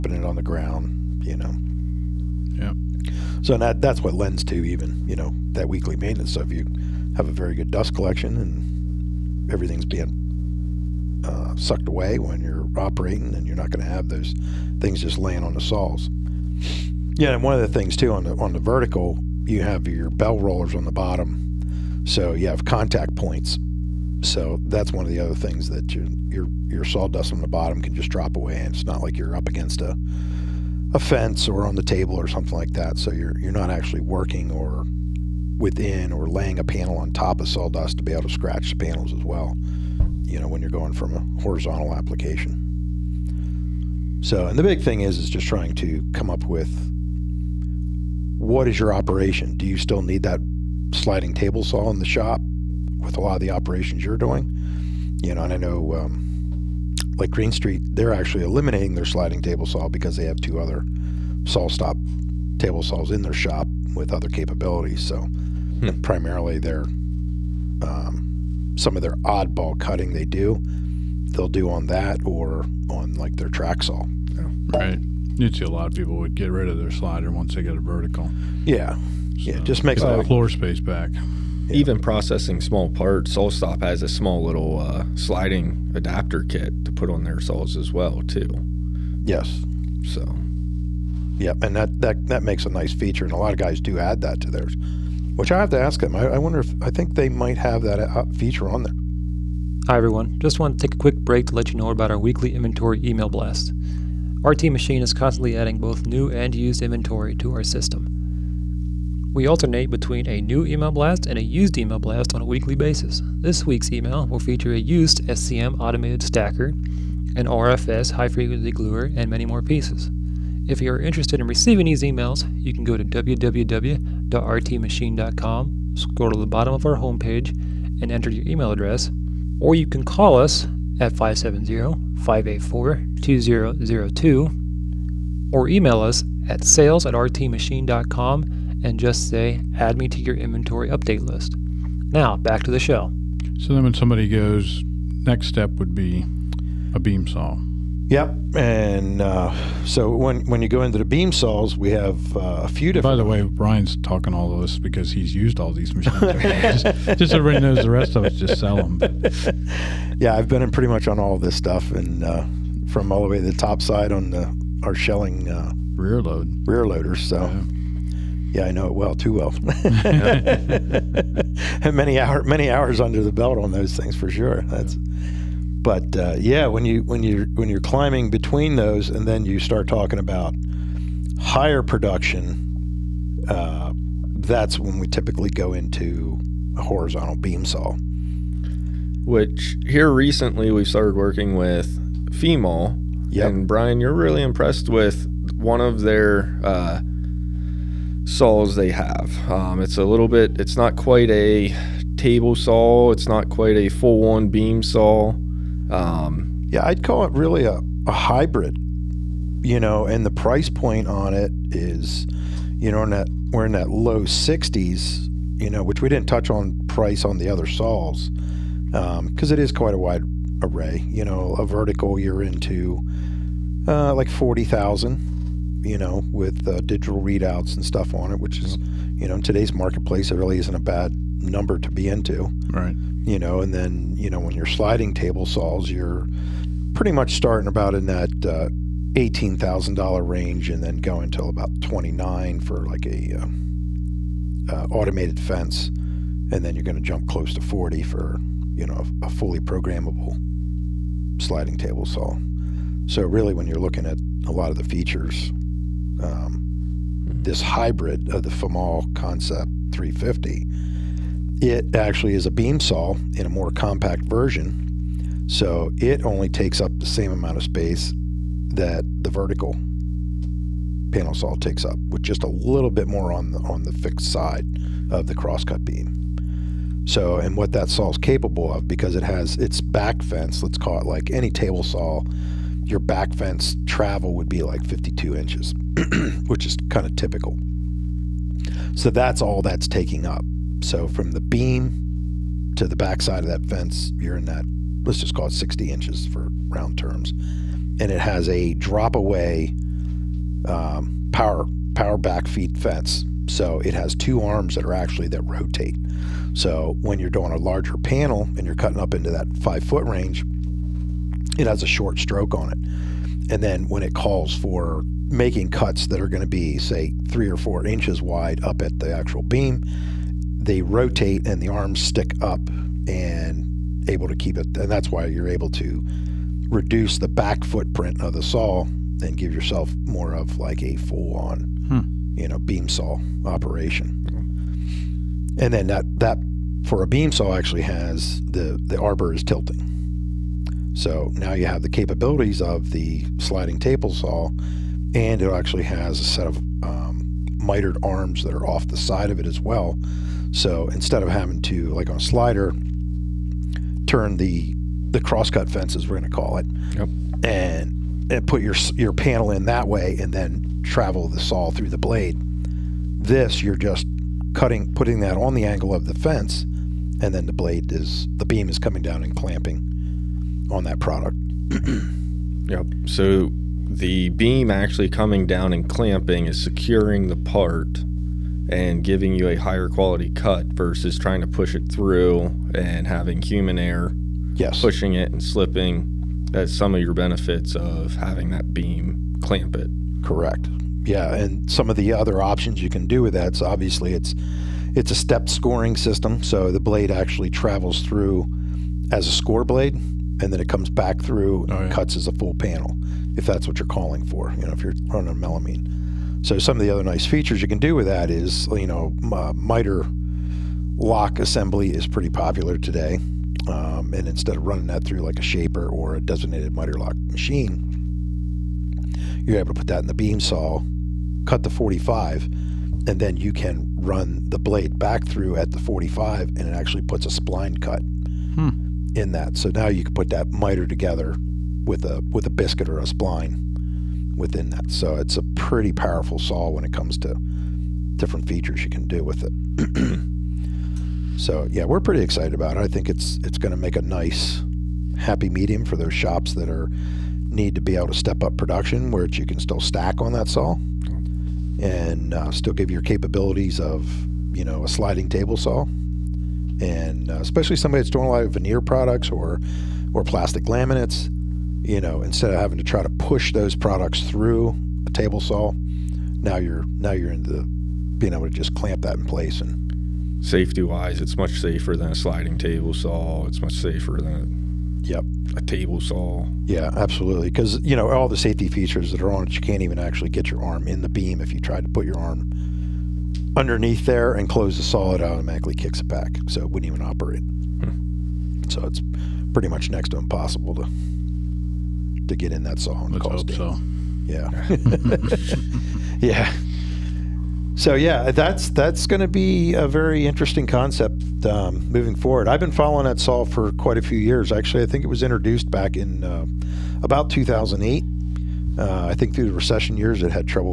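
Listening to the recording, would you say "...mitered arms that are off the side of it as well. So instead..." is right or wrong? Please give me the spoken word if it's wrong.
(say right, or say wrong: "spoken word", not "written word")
right.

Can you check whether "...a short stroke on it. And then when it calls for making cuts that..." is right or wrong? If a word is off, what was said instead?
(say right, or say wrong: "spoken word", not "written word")
right.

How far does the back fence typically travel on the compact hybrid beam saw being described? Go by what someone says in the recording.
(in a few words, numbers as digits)
52 inches.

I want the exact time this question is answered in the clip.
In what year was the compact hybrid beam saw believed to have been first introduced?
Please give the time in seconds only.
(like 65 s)
507 s.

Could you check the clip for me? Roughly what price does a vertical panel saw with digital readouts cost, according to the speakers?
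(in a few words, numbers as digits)
$40,000.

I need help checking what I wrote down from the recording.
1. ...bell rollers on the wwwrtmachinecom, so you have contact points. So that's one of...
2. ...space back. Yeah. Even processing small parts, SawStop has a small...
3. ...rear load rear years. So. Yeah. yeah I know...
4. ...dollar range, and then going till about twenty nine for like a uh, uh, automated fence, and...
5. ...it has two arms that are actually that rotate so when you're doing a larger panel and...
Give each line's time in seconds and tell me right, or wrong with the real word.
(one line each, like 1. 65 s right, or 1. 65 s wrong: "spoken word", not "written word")
1. 20 s wrong: "bottom", not "wwwrtmachinecom"
2. 80 s right
3. 165 s wrong: "loaders", not "years"
4. 239 s right
5. 303 s right.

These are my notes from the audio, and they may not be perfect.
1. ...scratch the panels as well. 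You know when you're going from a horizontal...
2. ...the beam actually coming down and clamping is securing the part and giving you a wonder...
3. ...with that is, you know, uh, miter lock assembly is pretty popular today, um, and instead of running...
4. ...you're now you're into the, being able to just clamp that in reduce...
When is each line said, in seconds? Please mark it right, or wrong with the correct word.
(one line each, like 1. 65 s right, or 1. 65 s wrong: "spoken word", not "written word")
1. 38 s right
2. 373 s wrong: "higher", not "wonder"
3. 407 s right
4. 466 s wrong: "place", not "reduce".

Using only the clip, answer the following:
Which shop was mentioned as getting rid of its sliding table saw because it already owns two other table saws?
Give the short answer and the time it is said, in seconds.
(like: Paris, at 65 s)
Greene Street, at 57 s.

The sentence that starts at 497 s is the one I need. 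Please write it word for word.
So yeah, that's that's going to be a very interesting concept um, moving forward.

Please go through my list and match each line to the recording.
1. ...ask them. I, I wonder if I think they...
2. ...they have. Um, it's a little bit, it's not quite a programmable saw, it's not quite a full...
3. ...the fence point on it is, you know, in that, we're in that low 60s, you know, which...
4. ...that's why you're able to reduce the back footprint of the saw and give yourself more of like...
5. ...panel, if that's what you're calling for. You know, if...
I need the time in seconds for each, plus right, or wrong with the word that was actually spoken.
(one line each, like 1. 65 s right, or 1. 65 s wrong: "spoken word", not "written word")
1. 95 s right
2. 198 s wrong: "table", not "programmable"
3. 210 s wrong: "price", not "fence"
4. 324 s right
5. 402 s right.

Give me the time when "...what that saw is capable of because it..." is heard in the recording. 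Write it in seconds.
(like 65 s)
277 s.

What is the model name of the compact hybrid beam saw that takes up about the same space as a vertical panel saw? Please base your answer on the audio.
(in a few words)
Concept 350.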